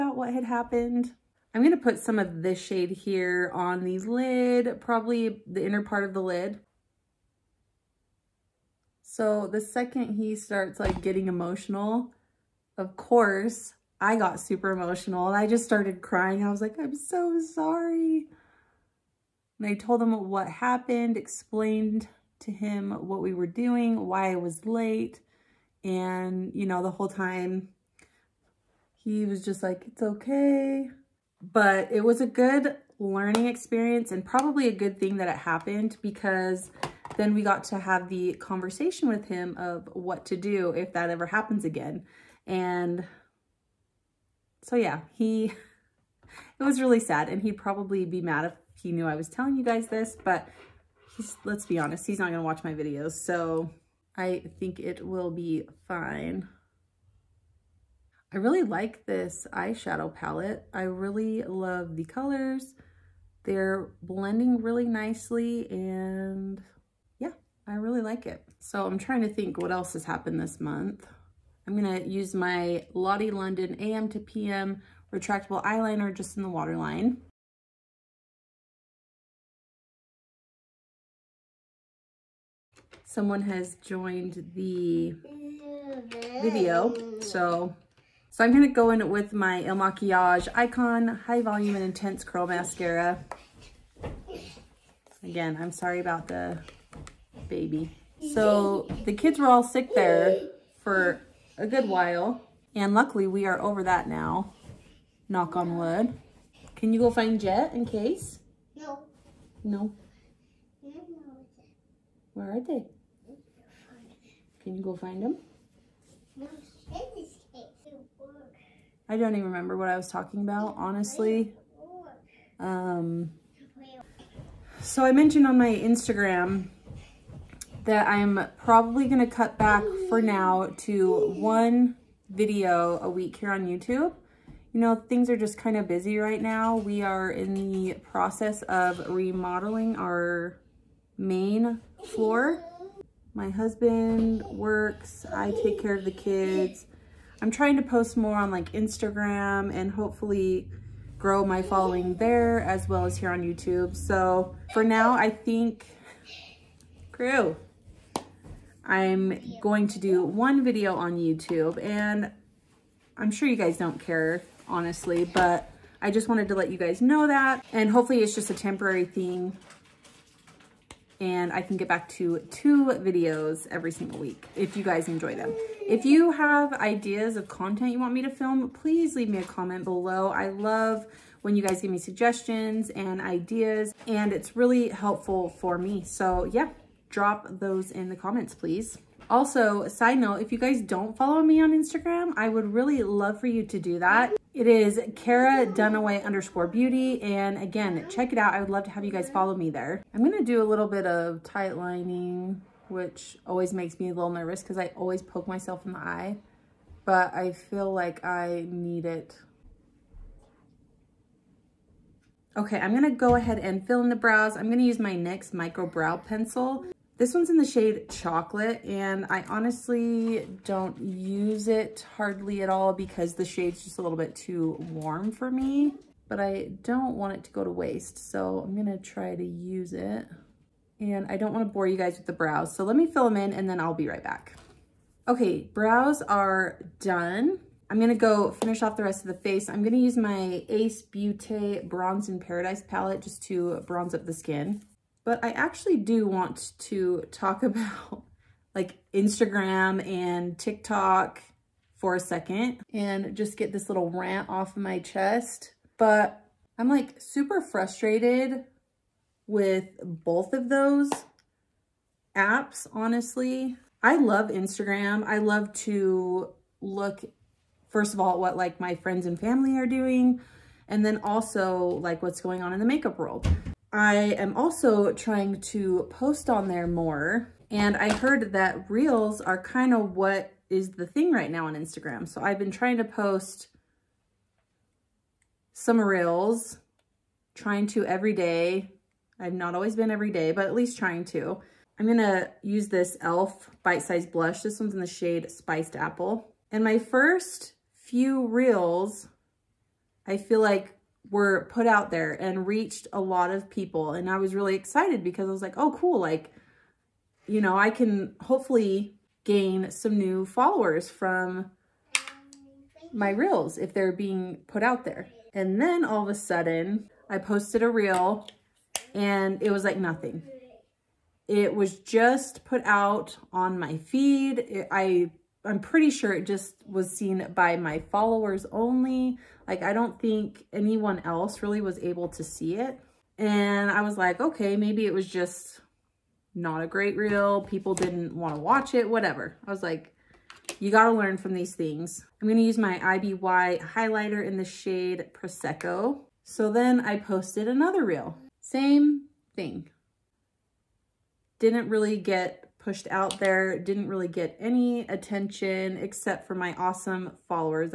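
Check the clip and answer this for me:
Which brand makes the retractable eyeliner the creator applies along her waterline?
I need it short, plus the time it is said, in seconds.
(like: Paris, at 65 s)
Lottie London, at 72 s.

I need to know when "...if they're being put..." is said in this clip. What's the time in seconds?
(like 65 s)
313 s.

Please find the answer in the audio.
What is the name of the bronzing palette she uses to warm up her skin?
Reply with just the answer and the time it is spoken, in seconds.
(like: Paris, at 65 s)
Bronze in Paradise, at 241 s.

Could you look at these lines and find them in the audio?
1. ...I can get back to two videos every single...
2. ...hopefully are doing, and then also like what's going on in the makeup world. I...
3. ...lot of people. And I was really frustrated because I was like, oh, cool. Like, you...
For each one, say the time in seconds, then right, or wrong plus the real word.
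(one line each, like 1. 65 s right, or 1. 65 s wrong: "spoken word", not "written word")
1. 171 s right
2. 269 s wrong: "family", not "hopefully"
3. 303 s wrong: "excited", not "frustrated".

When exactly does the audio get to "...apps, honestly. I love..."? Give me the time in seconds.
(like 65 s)
262 s.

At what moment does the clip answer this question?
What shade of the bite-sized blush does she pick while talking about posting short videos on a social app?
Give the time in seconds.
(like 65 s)
295 s.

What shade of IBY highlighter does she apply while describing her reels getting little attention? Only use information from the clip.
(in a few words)
Prosecco.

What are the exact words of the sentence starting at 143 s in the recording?
My husband works, I take care of the kids.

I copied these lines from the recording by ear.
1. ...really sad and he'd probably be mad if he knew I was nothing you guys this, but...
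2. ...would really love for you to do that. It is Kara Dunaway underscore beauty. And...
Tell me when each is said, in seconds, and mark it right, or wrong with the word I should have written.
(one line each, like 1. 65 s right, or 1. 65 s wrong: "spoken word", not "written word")
1. 46 s wrong: "telling", not "nothing"
2. 192 s right.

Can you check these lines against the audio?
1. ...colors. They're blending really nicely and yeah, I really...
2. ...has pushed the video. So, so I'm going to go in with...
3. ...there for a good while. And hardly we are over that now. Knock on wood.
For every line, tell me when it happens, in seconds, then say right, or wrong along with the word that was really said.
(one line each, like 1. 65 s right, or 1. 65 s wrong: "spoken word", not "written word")
1. 62 s right
2. 83 s wrong: "joined", not "pushed"
3. 99 s wrong: "luckily", not "hardly".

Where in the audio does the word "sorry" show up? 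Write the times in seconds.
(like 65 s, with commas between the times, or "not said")
17 s, 95 s.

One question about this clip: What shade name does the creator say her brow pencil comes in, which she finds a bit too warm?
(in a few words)
Chocolate.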